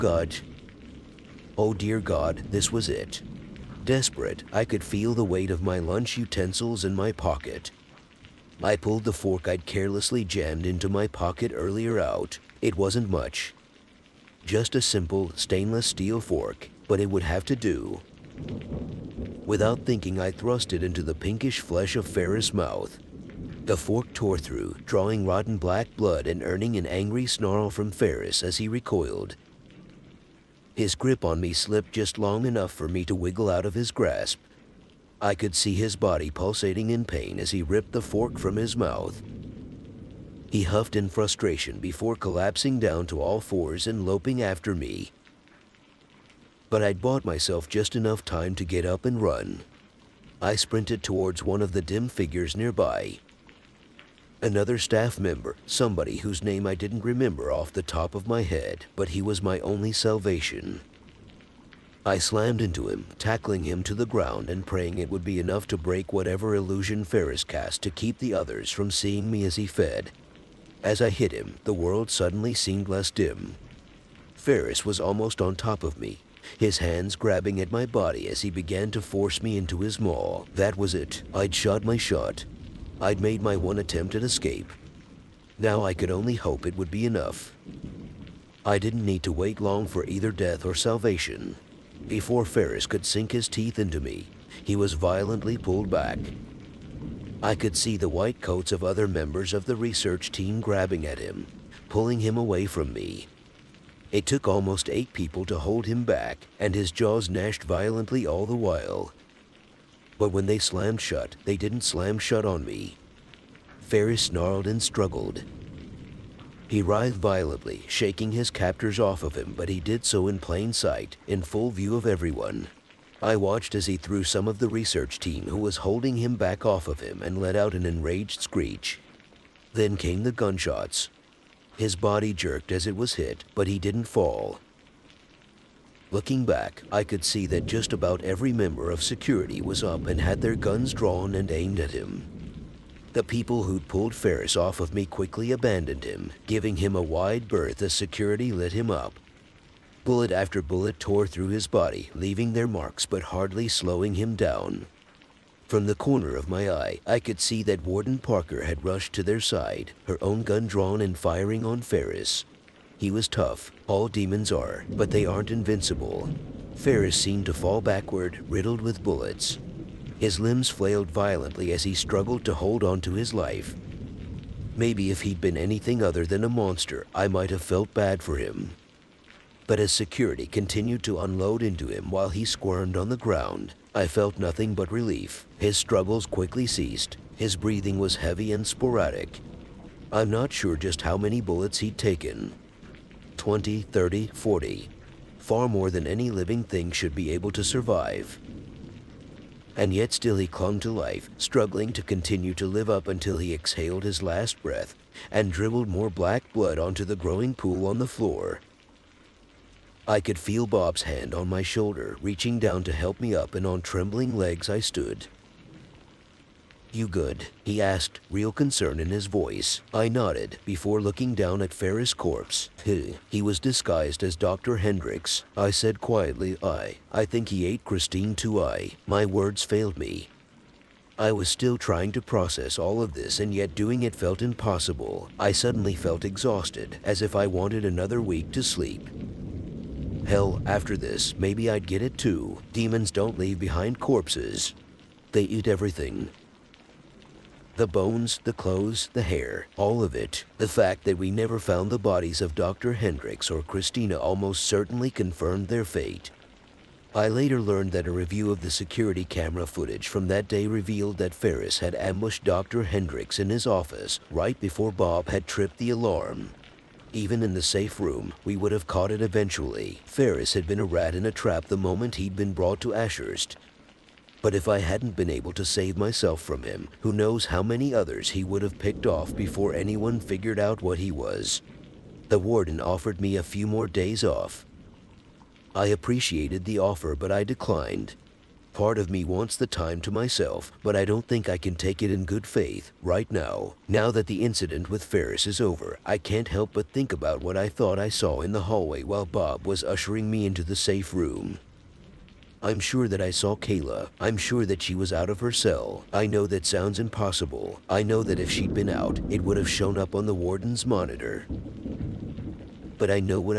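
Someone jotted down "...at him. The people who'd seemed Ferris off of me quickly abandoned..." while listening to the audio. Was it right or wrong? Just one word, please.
wrong.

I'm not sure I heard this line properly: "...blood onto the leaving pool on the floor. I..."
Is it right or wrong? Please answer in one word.
wrong.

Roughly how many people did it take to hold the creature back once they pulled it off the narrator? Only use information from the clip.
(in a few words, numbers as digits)
8.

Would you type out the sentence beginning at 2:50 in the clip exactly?
His limbs flailed violently as he struggled to hold on to his life.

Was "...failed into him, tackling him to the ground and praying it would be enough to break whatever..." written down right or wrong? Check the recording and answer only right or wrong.
wrong.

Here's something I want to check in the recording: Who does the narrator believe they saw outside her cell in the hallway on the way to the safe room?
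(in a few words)
Kayla.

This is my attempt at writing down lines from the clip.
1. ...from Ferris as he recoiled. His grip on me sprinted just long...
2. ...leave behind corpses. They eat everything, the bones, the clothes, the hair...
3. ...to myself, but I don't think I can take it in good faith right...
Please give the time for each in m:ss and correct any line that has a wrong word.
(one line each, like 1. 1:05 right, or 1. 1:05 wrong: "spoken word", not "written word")
1. 0:27 wrong: "slipped", not "sprinted"
2. 4:03 right
3. 4:50 right.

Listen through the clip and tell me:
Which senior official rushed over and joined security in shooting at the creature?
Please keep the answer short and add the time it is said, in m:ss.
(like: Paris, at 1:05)
Warden Parker, at 2:37.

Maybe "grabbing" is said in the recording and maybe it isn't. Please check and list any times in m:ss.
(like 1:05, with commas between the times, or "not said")
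1:17, 1:40.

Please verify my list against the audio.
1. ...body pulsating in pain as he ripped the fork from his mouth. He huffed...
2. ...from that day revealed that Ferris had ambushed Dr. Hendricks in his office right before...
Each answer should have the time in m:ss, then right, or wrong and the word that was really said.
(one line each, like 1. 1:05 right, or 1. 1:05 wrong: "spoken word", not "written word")
1. 0:35 right
2. 4:20 right.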